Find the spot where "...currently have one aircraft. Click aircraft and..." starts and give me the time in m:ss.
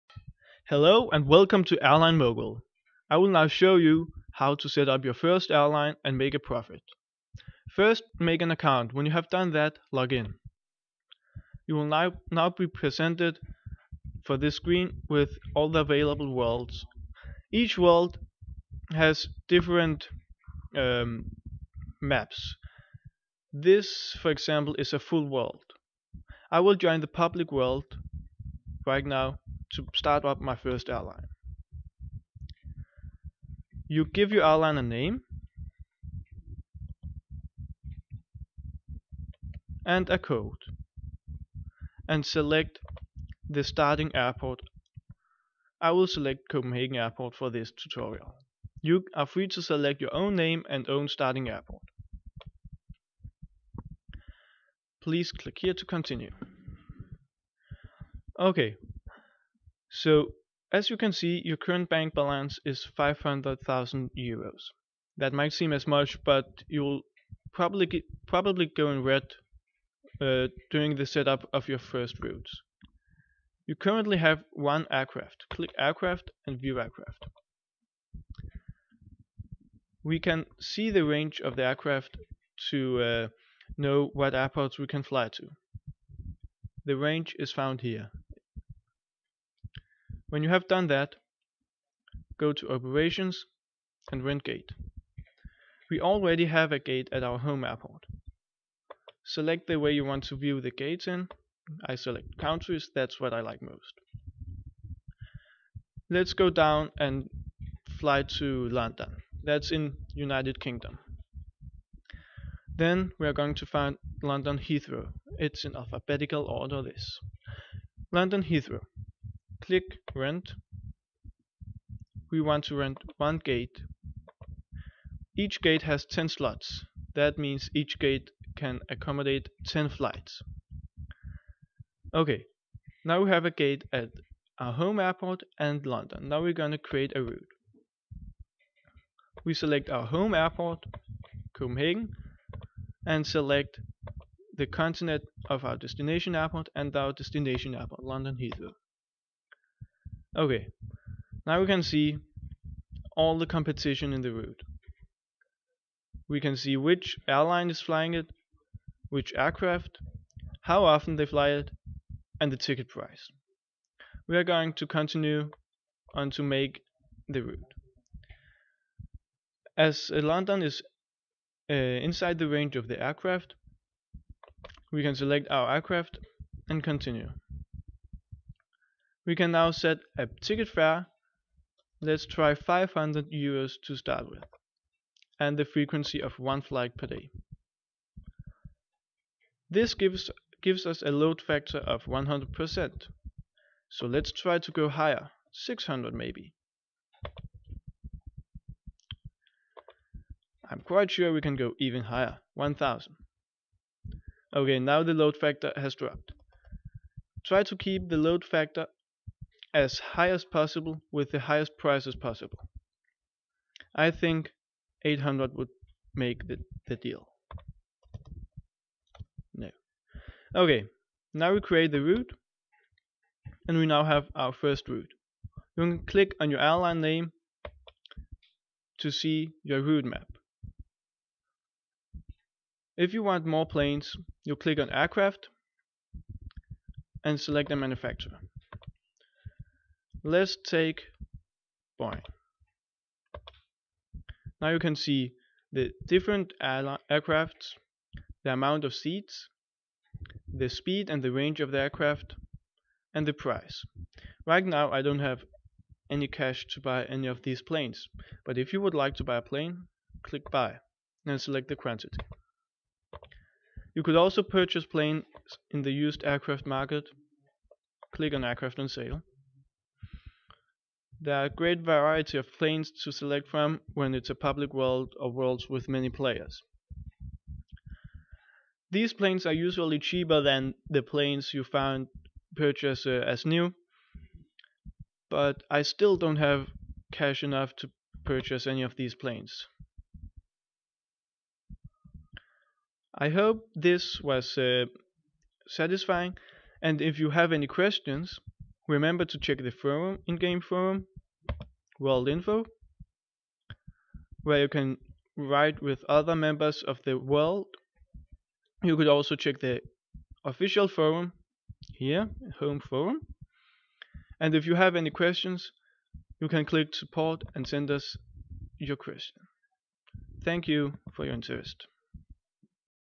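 1:13.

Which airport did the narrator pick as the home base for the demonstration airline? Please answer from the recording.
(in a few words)
Copenhagen Airport.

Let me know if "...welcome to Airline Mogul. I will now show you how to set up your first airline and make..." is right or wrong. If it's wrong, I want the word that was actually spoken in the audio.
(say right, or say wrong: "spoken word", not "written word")
right.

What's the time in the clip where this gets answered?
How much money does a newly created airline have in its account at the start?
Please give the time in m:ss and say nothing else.
1:02.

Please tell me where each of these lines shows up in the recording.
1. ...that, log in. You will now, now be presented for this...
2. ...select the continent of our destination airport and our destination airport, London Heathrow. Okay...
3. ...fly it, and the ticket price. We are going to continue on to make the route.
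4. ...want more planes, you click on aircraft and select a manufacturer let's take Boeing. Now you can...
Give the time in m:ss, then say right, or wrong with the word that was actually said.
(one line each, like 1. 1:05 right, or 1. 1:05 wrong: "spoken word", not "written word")
1. 0:09 right
2. 2:23 right
3. 2:41 right
4. 3:53 right.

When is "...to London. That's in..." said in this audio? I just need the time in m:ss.
1:48.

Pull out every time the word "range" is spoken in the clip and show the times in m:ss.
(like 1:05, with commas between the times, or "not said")
1:21, 1:26, 2:52, 4:11.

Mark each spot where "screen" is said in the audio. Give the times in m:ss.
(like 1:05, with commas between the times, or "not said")
0:14.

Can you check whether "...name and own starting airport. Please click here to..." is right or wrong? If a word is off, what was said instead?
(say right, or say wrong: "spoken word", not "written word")
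right.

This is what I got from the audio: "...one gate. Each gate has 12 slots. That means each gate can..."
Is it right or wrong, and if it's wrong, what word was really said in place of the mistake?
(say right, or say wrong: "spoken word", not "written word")
wrong: "10", not "12".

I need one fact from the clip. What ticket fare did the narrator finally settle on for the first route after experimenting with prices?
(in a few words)
800.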